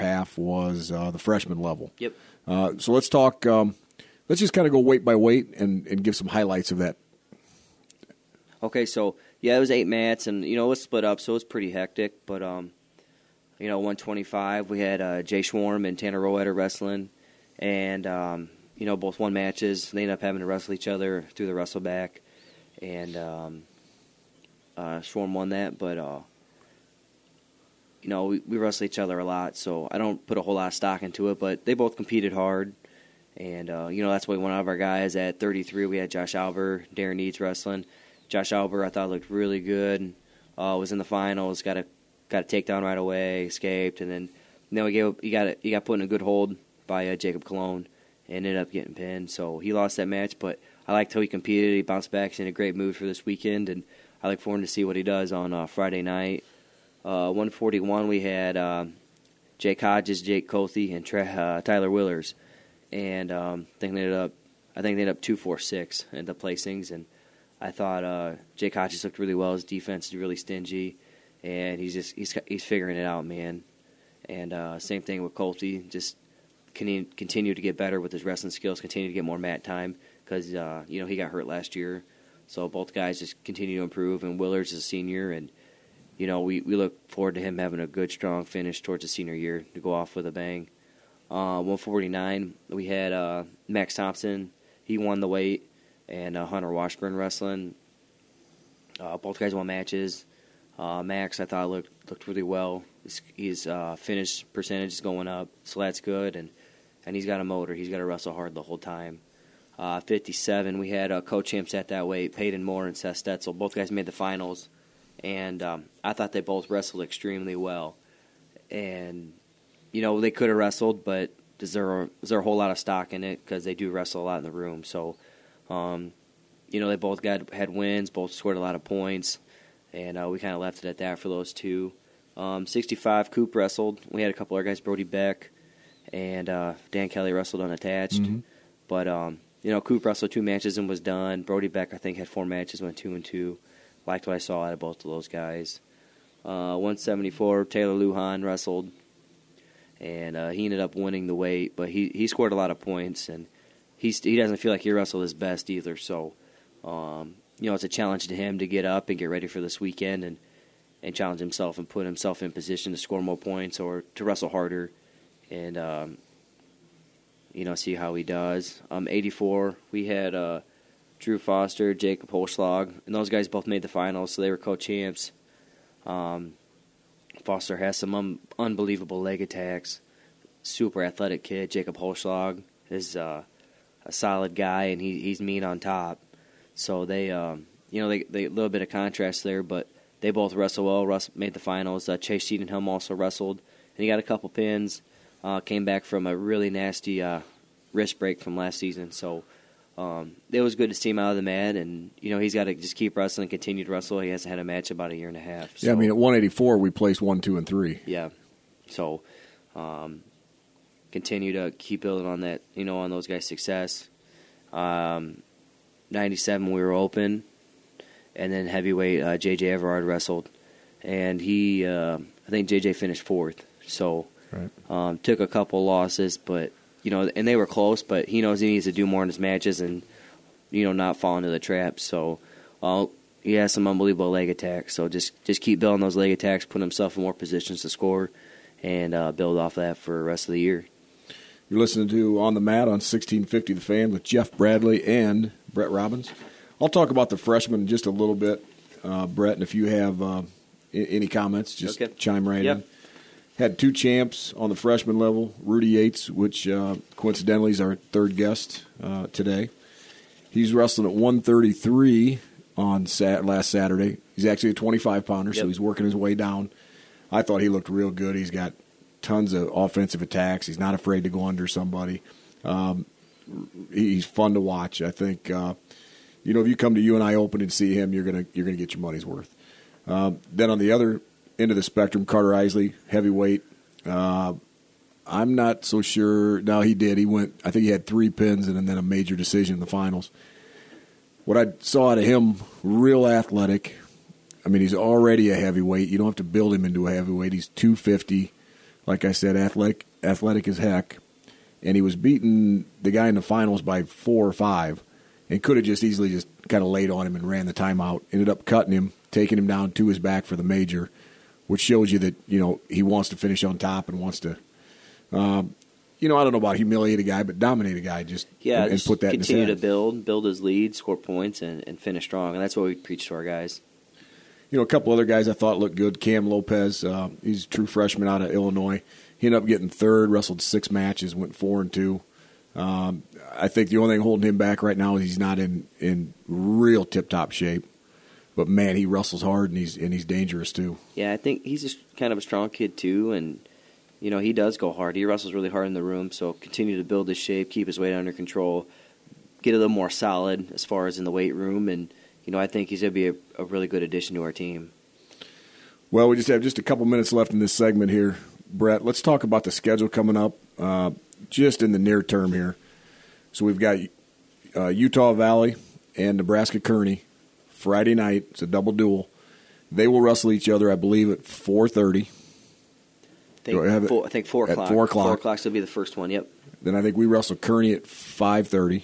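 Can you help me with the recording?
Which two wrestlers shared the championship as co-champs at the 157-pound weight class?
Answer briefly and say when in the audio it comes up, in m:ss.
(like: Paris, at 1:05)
Peyton Moore and Seth Stetzel, at 1:52.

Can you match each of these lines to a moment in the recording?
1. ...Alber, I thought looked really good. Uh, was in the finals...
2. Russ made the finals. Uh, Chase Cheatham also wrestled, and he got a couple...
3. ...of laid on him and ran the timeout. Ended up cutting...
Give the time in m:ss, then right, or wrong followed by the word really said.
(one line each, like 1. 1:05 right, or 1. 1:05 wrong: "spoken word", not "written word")
1. 0:38 right
2. 3:11 right
3. 5:06 right.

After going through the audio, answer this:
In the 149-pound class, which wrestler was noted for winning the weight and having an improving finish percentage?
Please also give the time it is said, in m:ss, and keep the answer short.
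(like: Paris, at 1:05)
Max Thompson, at 1:33.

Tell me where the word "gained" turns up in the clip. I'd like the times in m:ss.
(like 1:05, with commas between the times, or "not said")
not said.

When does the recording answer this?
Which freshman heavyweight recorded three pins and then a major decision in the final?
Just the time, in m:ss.
4:42.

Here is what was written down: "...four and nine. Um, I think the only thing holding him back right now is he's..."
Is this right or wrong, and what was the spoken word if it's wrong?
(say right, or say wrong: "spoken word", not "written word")
wrong: "two", not "nine".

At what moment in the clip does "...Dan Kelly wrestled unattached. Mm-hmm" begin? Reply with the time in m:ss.
2:16.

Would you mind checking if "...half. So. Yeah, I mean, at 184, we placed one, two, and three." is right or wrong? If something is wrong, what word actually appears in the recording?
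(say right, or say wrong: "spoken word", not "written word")
right.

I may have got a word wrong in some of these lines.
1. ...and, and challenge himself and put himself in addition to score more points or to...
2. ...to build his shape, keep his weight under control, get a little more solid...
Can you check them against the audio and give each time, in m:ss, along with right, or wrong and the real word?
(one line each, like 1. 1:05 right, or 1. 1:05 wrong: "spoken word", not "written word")
1. 2:40 wrong: "position", not "addition"
2. 5:46 right.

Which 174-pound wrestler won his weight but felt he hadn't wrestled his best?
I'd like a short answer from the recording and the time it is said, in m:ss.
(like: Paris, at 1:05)
Taylor Lujan, at 2:27.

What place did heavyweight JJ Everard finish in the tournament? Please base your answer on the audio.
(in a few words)
4th.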